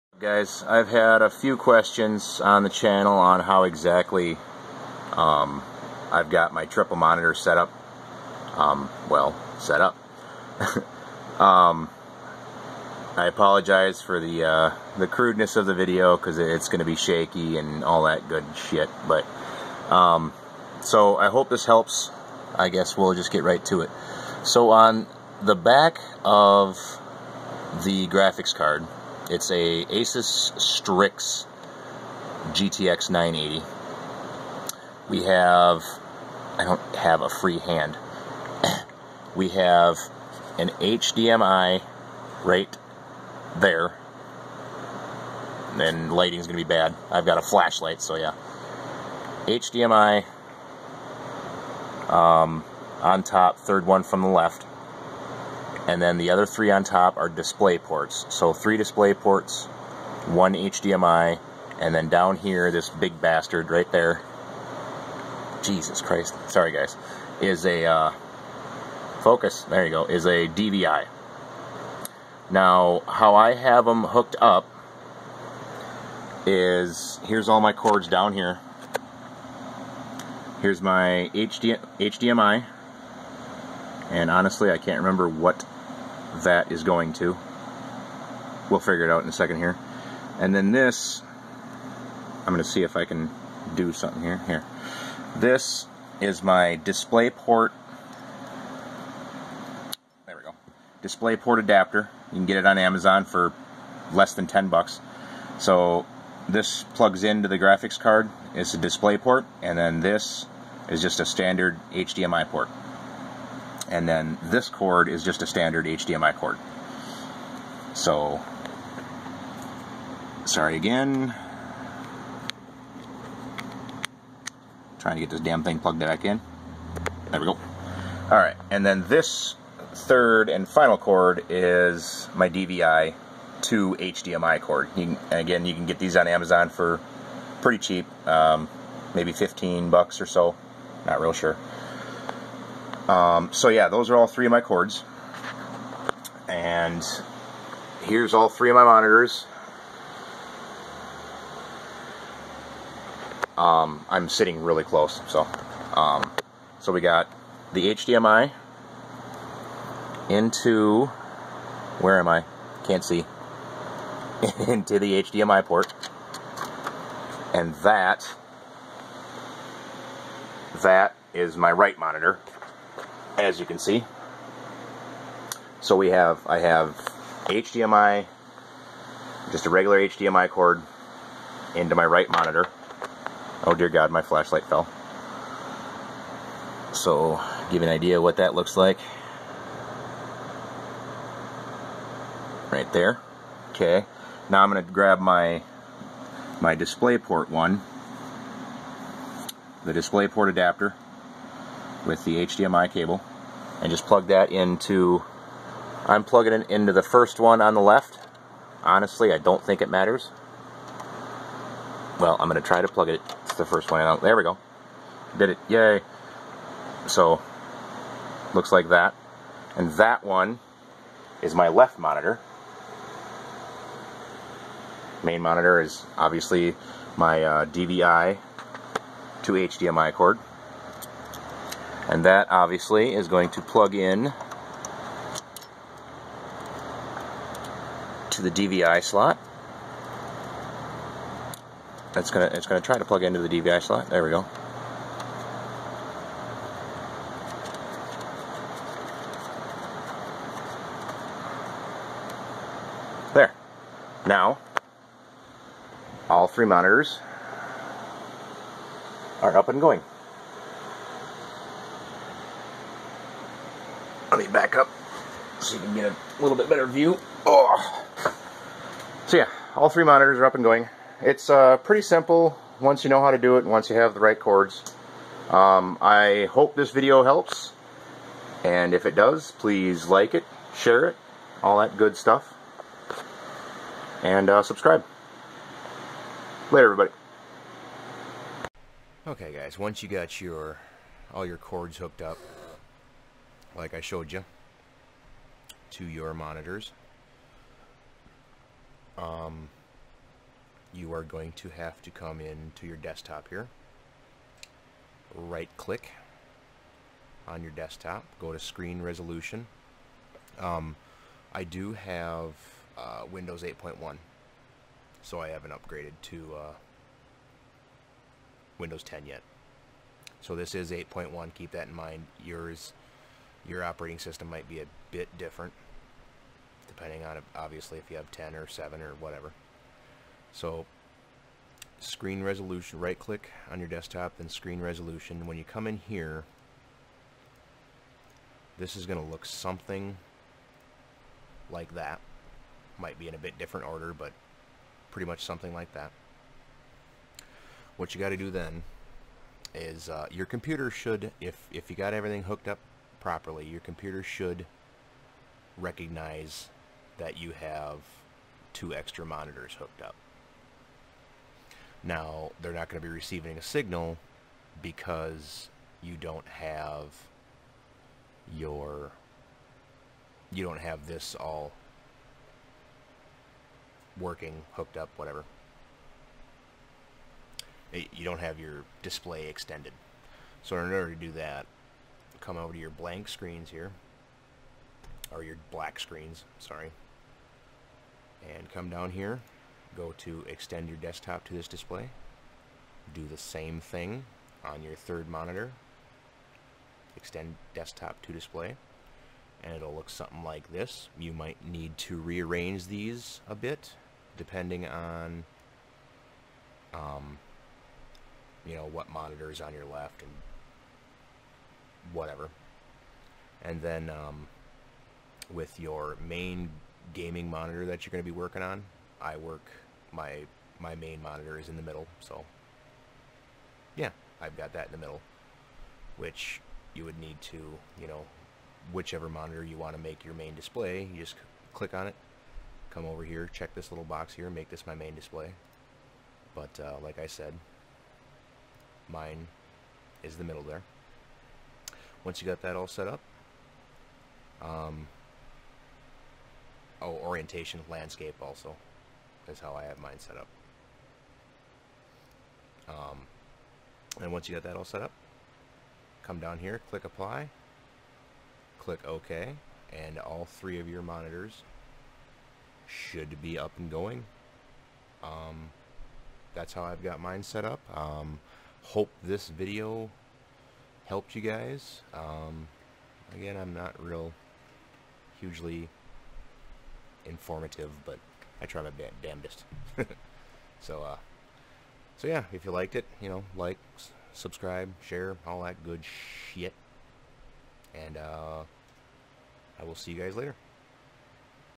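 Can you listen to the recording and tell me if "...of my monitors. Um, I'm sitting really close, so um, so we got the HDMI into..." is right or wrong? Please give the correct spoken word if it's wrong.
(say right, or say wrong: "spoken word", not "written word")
right.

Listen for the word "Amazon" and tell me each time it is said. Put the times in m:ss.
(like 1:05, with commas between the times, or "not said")
1:42, 2:16.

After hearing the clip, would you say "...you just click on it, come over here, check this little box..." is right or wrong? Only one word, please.
right.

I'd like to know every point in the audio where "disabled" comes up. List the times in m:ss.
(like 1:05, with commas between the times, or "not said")
not said.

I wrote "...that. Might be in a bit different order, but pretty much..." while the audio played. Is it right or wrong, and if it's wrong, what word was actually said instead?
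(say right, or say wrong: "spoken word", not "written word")
right.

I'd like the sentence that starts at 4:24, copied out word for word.
me back up so you can get a little bit better view.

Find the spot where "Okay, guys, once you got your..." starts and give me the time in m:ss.
4:49.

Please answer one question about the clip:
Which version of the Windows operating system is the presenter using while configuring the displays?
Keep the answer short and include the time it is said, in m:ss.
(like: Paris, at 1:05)
Windows 8.1, at 5:13.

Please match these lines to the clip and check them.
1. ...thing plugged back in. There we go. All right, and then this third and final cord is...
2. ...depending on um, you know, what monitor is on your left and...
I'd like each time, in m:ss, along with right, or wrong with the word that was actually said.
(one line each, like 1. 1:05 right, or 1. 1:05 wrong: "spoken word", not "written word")
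1. 2:05 right
2. 6:44 right.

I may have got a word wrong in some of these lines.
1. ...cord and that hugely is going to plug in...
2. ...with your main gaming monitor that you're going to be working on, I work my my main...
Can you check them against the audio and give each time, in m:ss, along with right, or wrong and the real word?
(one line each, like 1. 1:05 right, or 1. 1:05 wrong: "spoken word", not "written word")
1. 3:50 wrong: "obviously", not "hugely"
2. 6:55 right.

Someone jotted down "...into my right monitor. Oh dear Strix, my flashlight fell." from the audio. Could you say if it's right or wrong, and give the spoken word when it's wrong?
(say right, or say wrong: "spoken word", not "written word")
wrong: "God", not "Strix".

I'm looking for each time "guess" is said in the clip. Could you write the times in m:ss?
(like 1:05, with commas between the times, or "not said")
0:22.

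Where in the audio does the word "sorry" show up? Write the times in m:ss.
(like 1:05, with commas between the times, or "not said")
1:06, 2:00, 6:26.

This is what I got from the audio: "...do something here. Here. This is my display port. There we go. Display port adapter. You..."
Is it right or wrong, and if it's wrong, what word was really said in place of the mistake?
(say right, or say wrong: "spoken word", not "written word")
right.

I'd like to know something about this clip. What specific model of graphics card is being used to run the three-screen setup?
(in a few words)
Asus Strix GTX 980.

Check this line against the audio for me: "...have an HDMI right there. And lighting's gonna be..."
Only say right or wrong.
right.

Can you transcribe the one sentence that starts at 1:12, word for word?
Now, how I have them hooked up is, here's all my cords down here.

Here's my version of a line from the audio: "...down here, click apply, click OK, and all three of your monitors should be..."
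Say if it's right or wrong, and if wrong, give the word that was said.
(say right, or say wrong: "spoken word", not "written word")
right.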